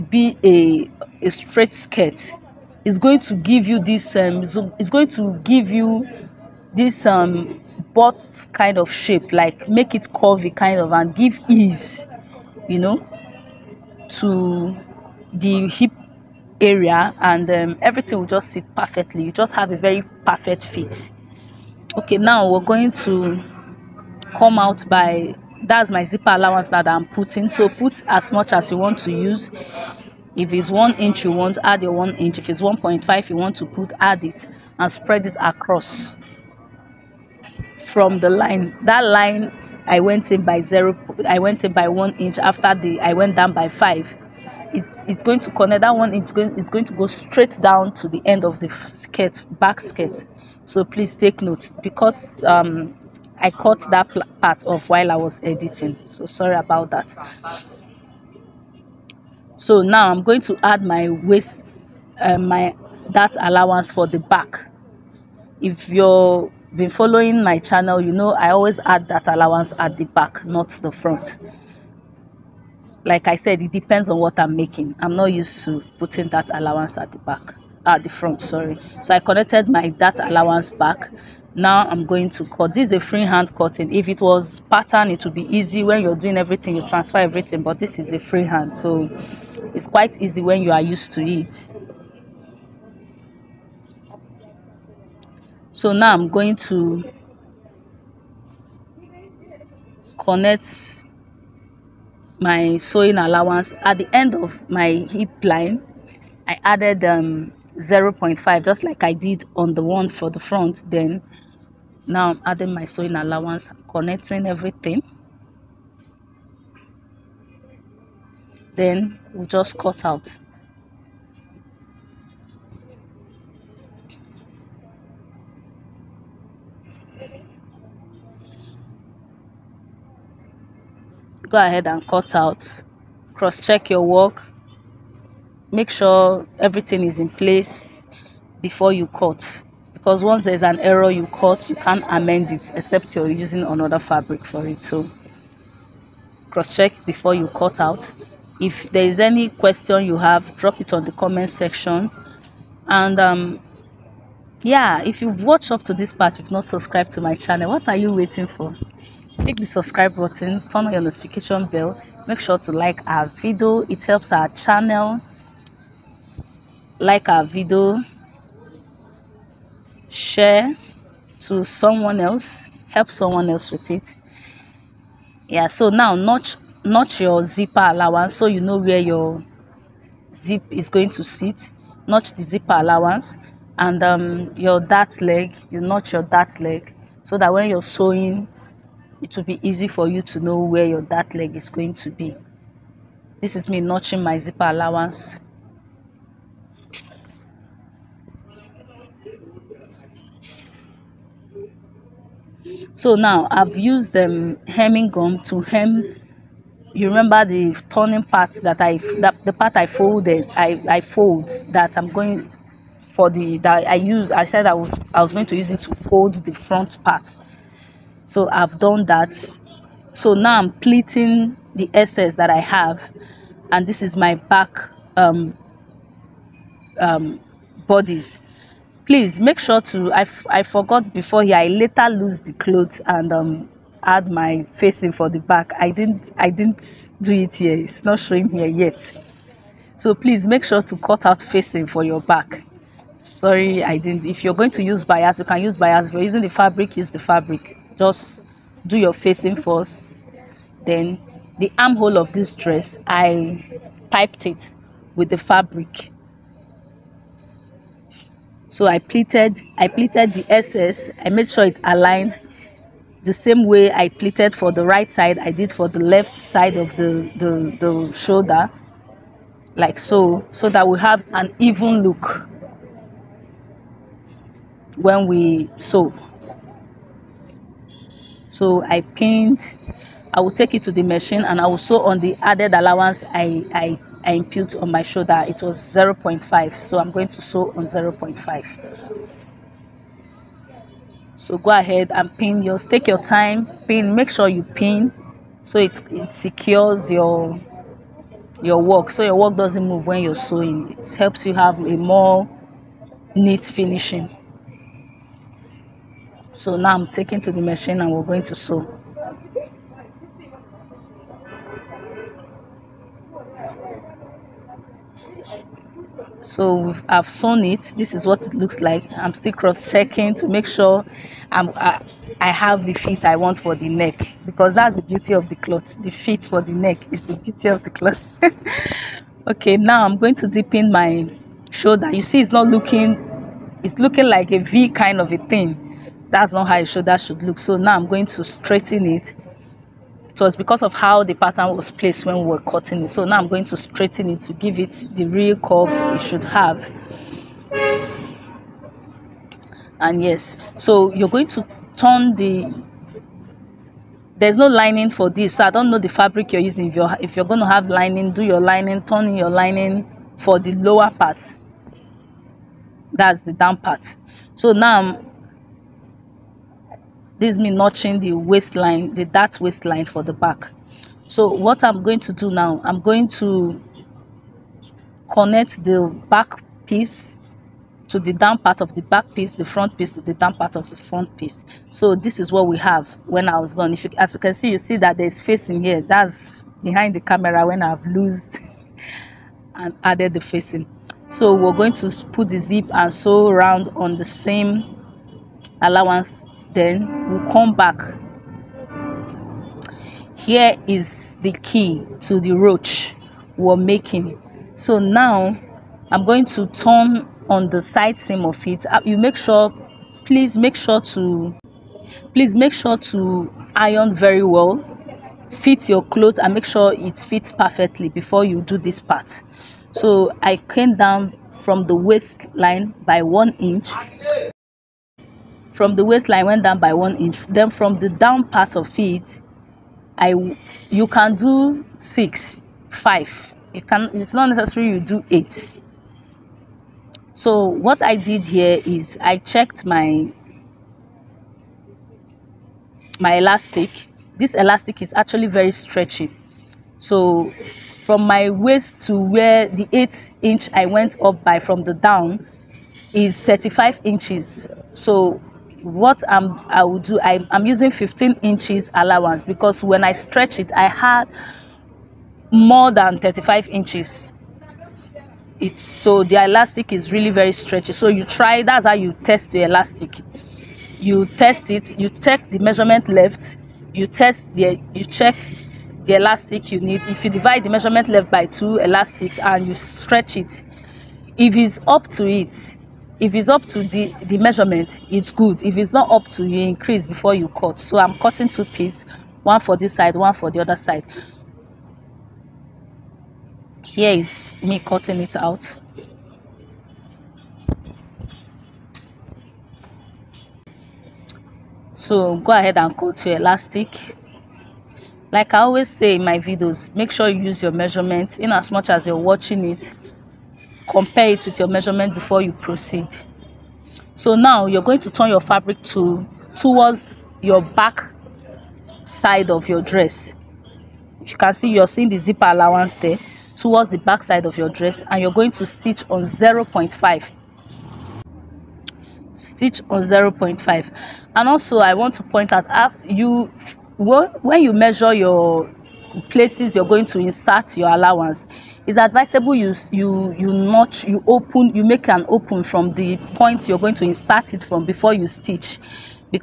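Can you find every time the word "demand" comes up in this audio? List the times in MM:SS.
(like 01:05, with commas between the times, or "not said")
not said.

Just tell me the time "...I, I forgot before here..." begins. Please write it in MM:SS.
03:50.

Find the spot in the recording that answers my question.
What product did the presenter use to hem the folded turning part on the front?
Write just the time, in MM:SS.
03:24.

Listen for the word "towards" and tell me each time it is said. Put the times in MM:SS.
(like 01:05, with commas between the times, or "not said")
08:36, 08:43.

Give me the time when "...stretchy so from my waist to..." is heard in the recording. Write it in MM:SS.
07:25.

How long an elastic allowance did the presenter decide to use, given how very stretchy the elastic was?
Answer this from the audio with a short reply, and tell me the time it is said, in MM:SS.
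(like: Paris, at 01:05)
15 inches, at 07:37.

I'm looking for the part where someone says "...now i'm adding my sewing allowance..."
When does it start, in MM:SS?
01:52.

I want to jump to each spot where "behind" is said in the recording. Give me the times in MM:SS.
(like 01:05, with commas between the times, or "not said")
06:26.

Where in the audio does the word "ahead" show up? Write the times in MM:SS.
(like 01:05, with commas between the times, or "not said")
02:11, 04:51, 08:22.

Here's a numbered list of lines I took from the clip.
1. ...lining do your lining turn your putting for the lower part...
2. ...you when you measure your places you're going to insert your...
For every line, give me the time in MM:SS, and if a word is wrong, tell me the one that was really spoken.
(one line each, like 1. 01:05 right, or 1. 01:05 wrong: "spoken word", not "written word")
1. 05:57 wrong: "lining", not "putting"
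2. 08:53 right.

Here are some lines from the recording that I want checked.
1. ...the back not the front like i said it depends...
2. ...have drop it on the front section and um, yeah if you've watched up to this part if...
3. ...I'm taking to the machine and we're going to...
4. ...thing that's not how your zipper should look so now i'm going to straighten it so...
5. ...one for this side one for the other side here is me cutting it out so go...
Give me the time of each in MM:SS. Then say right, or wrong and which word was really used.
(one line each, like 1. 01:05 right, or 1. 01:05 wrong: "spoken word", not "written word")
1. 01:09 right
2. 02:30 wrong: "comment", not "front"
3. 05:06 right
4. 05:35 wrong: "shoulder", not "zipper"
5. 08:09 right.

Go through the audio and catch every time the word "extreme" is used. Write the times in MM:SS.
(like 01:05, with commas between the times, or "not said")
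not said.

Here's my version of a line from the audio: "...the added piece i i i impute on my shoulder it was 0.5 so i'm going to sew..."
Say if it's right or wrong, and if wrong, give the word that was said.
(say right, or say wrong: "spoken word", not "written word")
wrong: "allowance", not "piece".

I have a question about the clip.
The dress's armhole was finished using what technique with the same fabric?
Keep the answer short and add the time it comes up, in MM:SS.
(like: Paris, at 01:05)
piped, at 04:14.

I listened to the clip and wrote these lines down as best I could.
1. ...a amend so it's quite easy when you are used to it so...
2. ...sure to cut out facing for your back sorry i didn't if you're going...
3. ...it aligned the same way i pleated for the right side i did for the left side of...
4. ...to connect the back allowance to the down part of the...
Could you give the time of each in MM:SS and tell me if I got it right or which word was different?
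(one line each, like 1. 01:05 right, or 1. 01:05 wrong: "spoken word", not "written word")
1. 01:28 wrong: "freehand", not "amend"
2. 04:00 right
3. 04:21 right
4. 06:13 wrong: "piece", not "allowance".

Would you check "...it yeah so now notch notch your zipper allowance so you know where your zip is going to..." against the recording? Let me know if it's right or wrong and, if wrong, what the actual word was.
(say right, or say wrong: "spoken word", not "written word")
right.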